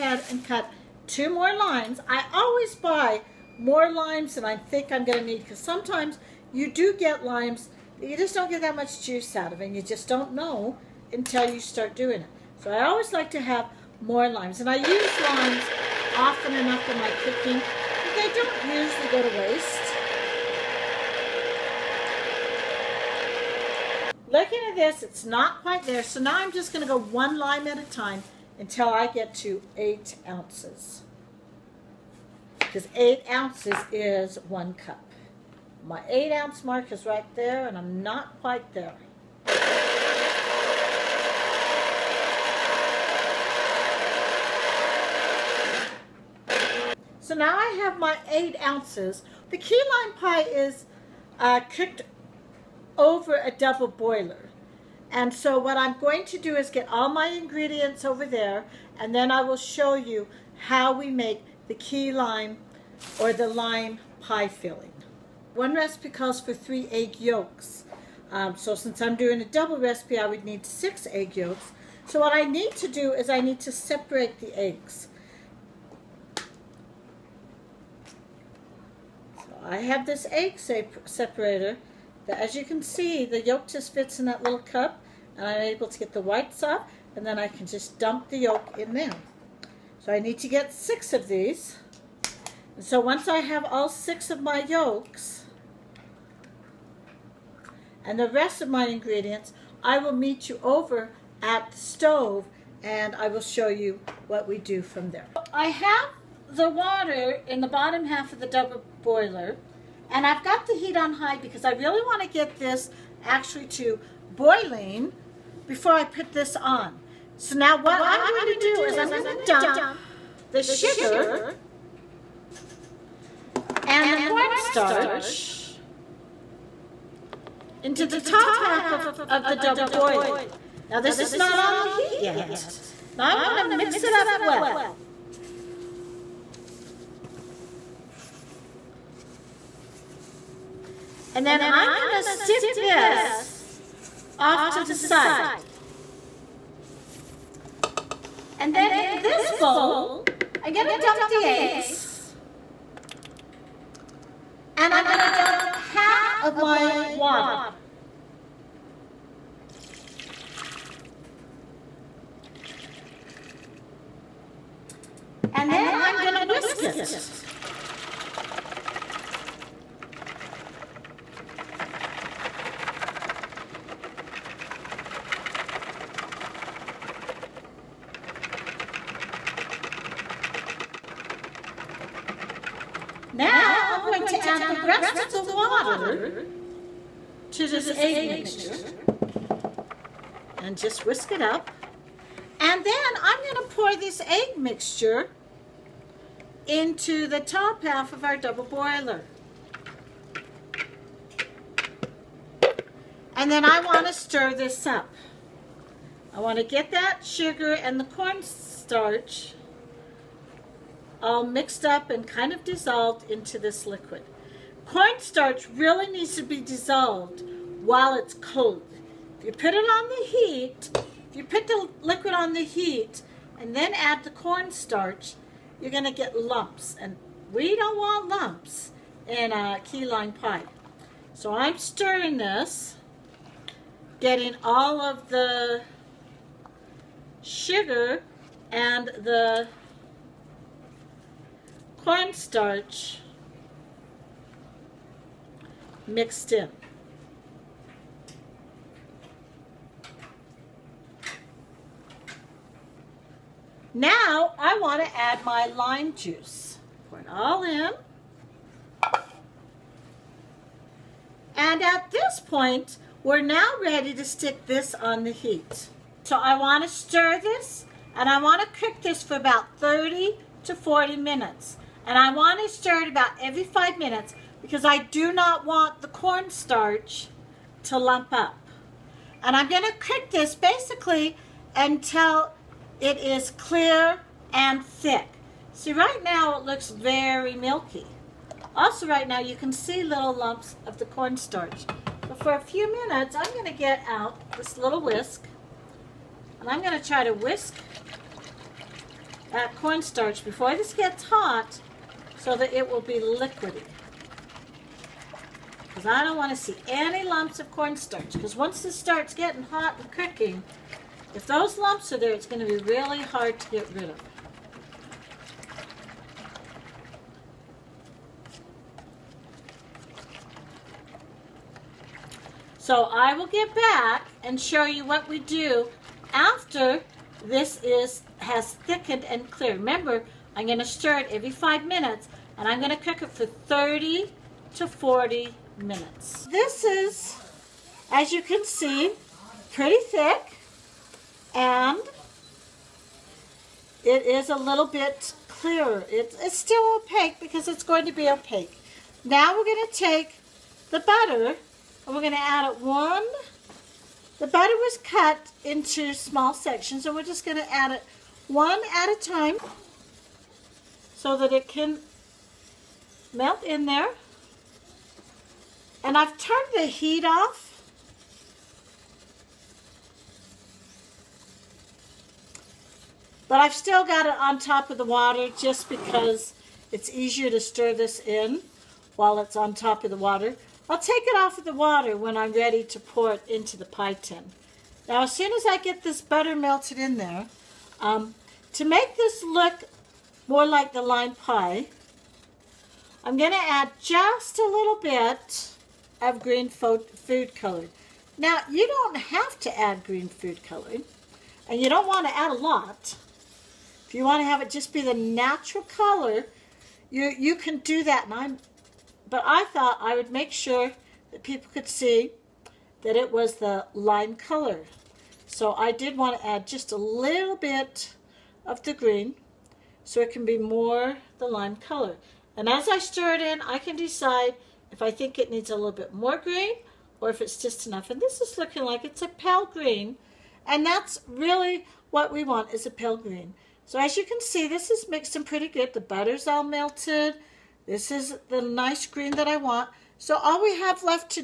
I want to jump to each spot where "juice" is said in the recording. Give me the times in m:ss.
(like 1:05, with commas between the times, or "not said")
0:09, 4:16.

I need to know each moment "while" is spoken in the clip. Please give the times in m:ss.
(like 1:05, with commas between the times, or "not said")
3:37, 6:19.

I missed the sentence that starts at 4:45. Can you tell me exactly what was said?
See, right now it looks very milky.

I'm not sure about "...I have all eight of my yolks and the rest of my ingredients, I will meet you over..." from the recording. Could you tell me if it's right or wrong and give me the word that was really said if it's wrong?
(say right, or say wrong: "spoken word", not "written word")
wrong: "six", not "eight".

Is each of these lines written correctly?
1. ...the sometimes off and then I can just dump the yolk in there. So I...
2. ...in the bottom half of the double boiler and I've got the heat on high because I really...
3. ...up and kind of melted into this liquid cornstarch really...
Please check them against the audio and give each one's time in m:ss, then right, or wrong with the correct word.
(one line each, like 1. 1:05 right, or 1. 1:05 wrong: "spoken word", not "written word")
1. 1:26 wrong: "whites", not "sometimes"
2. 1:47 right
3. 3:31 wrong: "dissolved", not "melted".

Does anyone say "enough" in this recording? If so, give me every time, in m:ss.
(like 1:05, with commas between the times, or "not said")
0:16, 7:07.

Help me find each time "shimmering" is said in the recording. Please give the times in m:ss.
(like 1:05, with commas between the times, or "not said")
not said.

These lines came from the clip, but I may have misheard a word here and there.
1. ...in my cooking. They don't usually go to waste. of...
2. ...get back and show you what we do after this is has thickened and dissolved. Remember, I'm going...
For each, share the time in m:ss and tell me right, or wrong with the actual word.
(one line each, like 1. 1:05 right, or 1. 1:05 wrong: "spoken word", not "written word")
1. 0:16 right
2. 5:23 wrong: "cleared", not "dissolved".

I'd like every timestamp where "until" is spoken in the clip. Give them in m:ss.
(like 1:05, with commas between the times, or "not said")
0:11, 0:28, 4:41.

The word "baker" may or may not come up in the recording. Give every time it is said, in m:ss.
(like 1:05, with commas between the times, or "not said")
not said.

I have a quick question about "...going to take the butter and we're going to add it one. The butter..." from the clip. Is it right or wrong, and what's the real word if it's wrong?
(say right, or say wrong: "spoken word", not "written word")
right.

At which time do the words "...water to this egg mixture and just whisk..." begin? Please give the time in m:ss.
3:05.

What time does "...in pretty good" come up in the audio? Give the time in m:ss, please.
7:15.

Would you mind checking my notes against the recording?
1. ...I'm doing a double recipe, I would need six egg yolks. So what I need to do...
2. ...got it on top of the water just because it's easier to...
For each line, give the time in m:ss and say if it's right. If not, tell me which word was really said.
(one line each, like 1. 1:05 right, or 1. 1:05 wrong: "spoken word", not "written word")
1. 1:09 right
2. 6:14 right.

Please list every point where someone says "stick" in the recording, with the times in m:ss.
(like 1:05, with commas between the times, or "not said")
2:22, 4:24.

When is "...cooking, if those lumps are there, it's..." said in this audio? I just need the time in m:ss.
5:10.